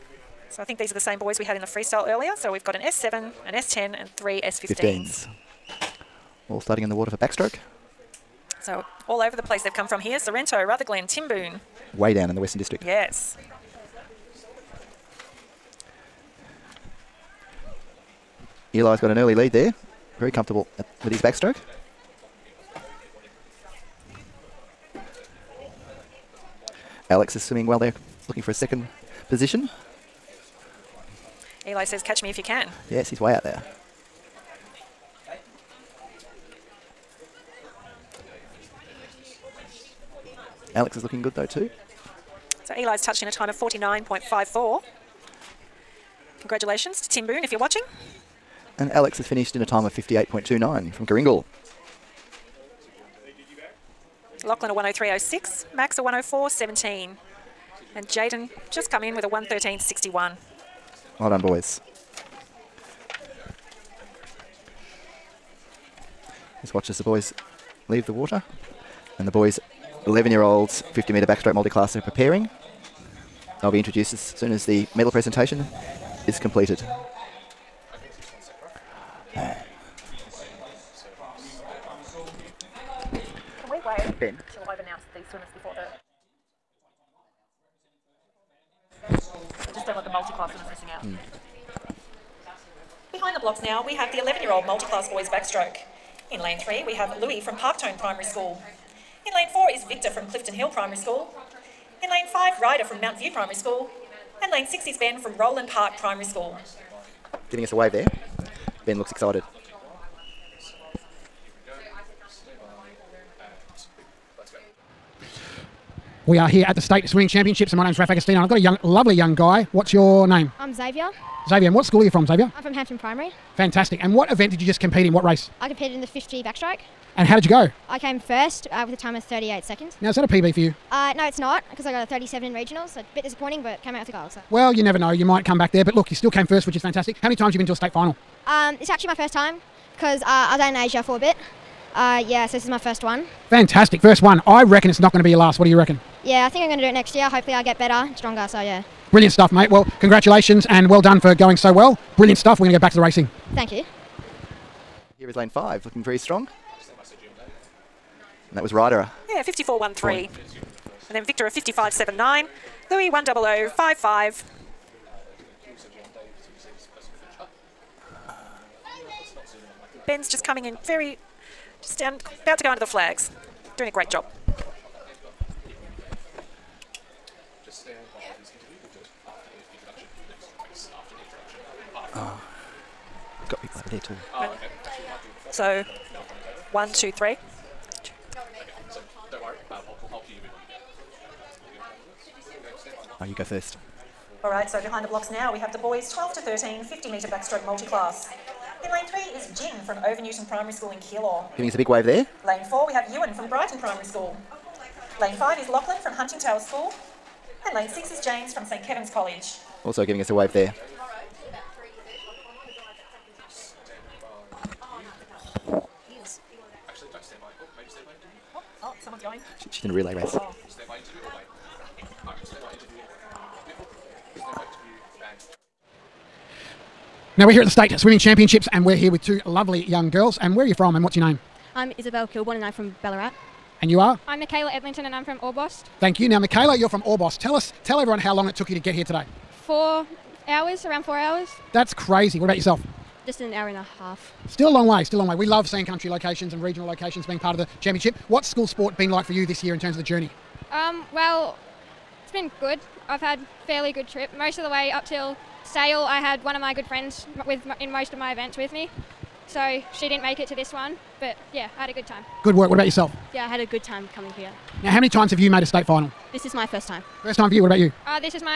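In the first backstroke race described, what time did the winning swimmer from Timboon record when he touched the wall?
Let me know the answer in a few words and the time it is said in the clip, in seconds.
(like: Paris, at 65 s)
49.54, at 43 s.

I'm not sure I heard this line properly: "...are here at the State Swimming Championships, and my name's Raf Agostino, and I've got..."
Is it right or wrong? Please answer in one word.
right.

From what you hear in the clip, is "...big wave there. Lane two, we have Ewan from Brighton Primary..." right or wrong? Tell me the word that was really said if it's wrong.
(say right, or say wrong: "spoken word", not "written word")
wrong: "four", not "two".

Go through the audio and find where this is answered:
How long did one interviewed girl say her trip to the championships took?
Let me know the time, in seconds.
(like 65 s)
243 s.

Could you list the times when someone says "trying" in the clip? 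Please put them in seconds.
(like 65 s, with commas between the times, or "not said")
not said.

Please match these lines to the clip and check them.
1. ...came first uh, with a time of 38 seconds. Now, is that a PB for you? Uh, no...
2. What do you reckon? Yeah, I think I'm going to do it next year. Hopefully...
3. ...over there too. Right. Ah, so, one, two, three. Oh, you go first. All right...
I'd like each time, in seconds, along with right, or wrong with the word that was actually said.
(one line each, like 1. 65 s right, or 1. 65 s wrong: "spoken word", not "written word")
1. 127 s right
2. 145 s right
3. 183 s right.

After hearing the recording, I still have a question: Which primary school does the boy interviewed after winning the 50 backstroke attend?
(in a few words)
Hampton Primary.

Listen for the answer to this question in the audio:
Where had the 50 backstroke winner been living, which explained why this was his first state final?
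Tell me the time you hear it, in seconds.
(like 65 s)
140 s.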